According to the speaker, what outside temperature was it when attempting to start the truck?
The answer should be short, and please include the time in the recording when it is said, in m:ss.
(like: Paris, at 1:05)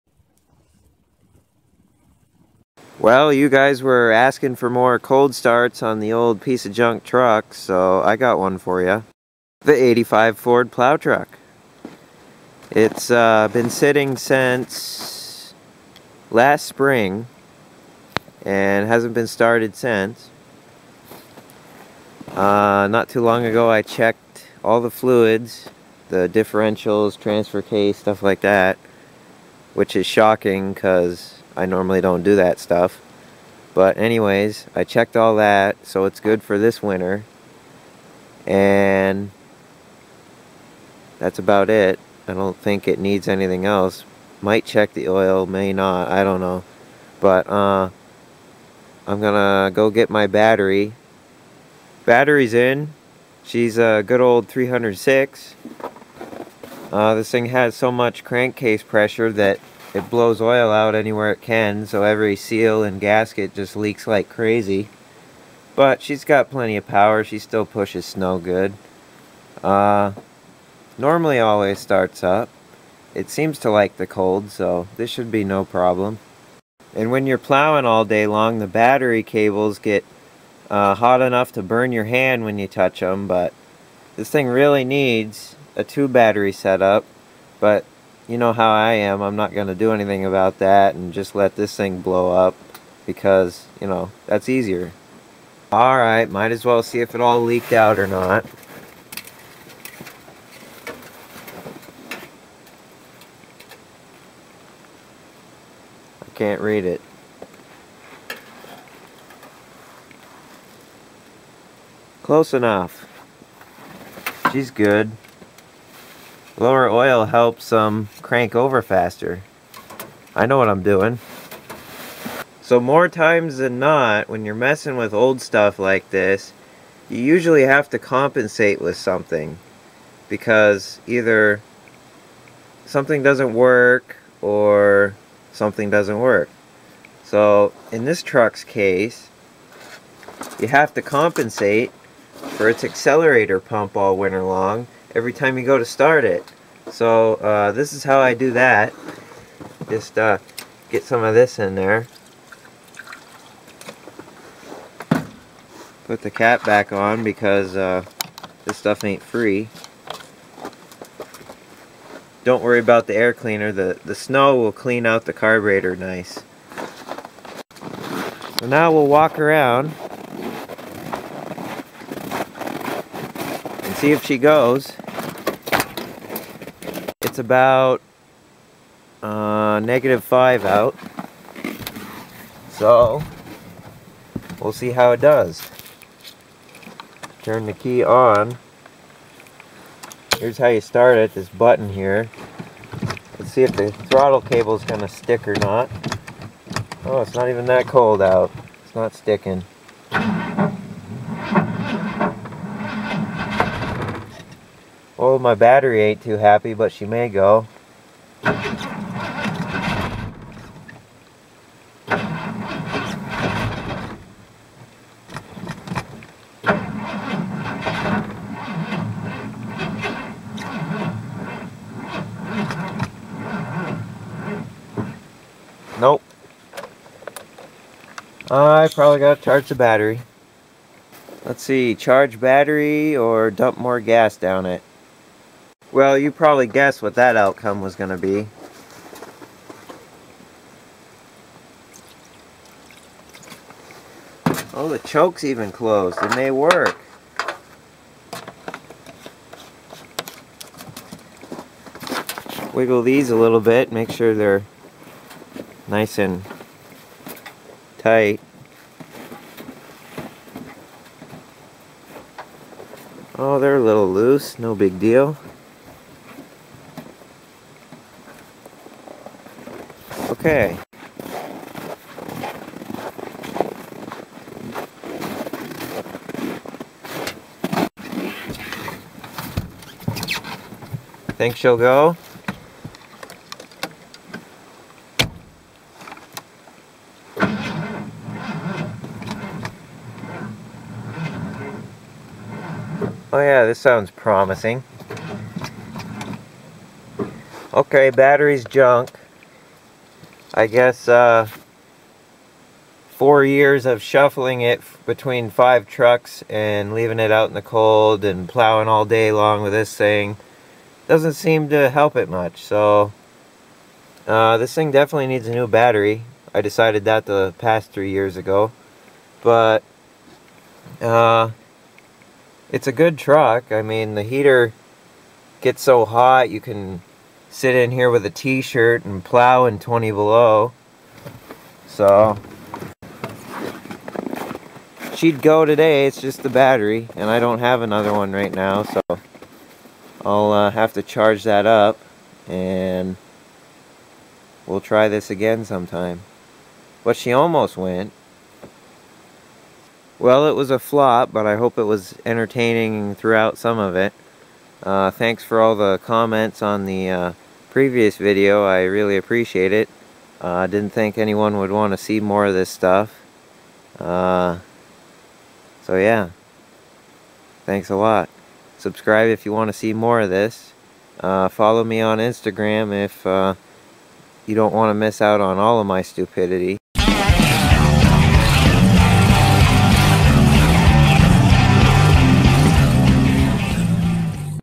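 negative 5, at 2:59.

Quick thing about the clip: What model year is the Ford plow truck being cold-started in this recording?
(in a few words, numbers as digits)
85.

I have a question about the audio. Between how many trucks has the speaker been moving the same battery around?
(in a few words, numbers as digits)
5.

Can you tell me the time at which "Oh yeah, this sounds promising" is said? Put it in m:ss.
4:53.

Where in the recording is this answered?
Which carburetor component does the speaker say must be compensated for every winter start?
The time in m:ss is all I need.
2:22.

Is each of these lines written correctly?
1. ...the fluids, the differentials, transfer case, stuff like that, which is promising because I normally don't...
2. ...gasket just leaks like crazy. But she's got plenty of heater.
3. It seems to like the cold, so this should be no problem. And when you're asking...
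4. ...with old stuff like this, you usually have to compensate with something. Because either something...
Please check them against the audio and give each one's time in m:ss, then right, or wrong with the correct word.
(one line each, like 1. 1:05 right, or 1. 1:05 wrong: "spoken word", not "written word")
1. 0:24 wrong: "shocking", not "promising"
2. 1:03 wrong: "power", not "heater"
3. 1:13 wrong: "plowing", not "asking"
4. 2:04 right.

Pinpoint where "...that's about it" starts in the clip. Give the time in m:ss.
0:41.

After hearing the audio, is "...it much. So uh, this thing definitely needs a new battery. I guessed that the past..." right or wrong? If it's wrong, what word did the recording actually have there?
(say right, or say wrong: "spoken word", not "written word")
wrong: "decided", not "guessed".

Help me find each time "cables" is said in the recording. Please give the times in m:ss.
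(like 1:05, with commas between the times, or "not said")
1:19, 3:14.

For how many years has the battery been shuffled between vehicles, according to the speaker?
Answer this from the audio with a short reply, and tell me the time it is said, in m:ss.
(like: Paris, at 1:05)
4, at 5:03.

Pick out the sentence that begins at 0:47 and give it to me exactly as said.
But uh, I'm gonna go get my battery.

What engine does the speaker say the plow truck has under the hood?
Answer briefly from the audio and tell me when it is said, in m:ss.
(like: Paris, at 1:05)
300 six, at 0:54.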